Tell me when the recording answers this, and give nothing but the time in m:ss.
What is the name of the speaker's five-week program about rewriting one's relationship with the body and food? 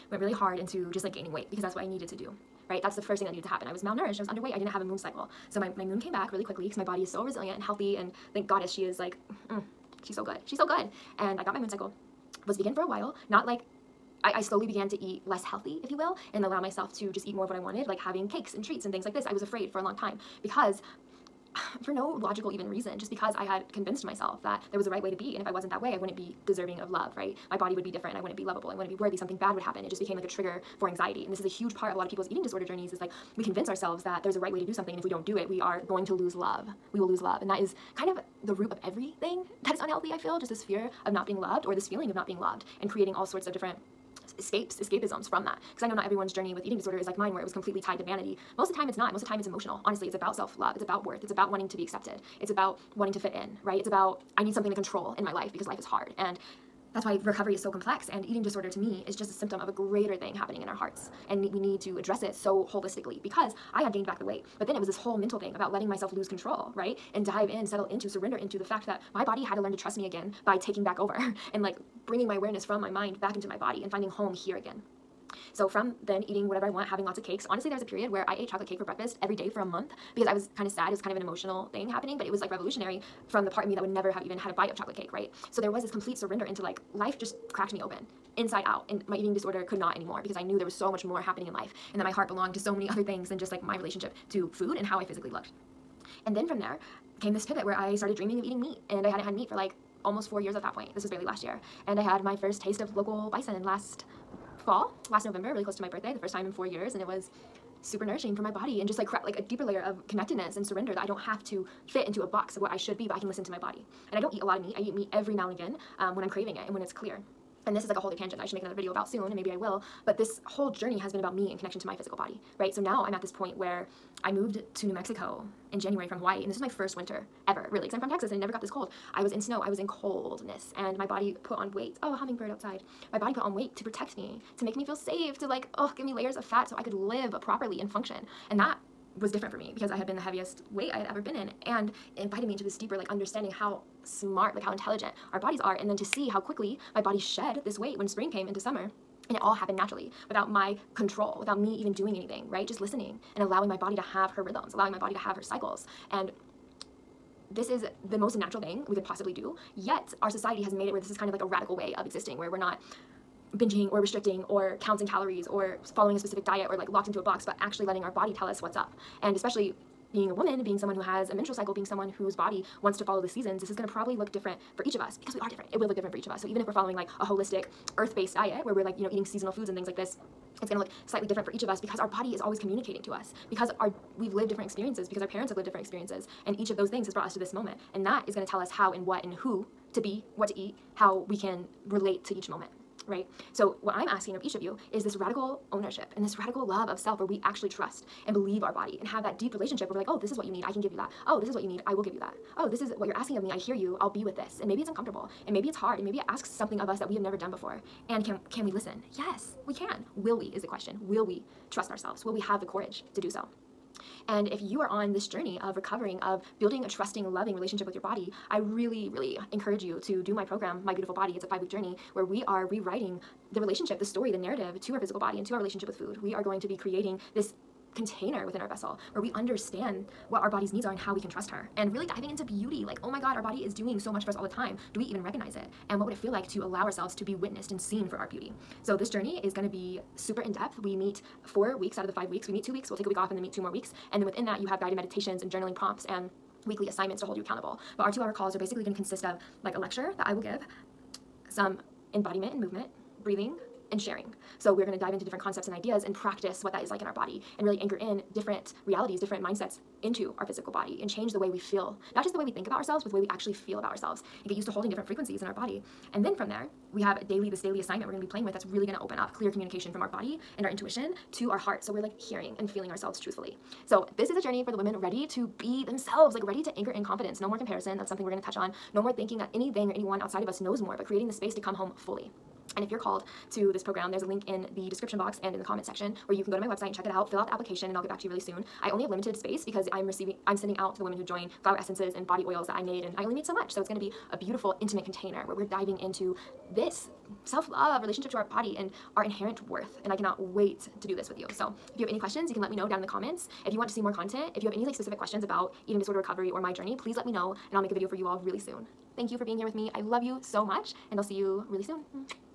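3:40.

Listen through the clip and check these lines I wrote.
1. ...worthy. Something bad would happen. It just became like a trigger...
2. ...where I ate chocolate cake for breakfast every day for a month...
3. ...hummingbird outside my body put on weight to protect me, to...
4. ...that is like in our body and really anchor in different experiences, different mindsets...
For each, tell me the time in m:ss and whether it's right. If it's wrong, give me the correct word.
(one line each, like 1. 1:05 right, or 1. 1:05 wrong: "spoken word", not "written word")
1. 0:28 right
2. 1:18 right
3. 2:12 right
4. 4:16 wrong: "realities", not "experiences".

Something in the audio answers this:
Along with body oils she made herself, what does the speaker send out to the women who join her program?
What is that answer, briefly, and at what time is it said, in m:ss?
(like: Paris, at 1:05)
Flower essences, at 4:51.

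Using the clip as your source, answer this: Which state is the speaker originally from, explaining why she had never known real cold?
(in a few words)
Texas.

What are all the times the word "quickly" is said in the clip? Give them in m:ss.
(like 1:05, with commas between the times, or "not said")
0:06, 2:26.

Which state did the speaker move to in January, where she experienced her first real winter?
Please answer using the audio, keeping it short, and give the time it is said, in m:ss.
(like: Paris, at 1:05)
New Mexico, at 2:04.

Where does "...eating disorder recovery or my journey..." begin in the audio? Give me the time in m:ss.
5:05.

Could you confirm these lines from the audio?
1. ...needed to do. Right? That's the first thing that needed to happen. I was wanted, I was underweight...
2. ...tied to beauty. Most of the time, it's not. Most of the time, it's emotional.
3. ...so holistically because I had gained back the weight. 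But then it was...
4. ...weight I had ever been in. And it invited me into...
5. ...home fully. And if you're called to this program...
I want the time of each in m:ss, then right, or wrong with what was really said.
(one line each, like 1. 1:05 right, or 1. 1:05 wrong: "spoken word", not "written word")
1. 0:01 wrong: "malnourished", not "wanted"
2. 0:47 wrong: "vanity", not "beauty"
3. 1:02 right
4. 2:20 right
5. 4:41 right.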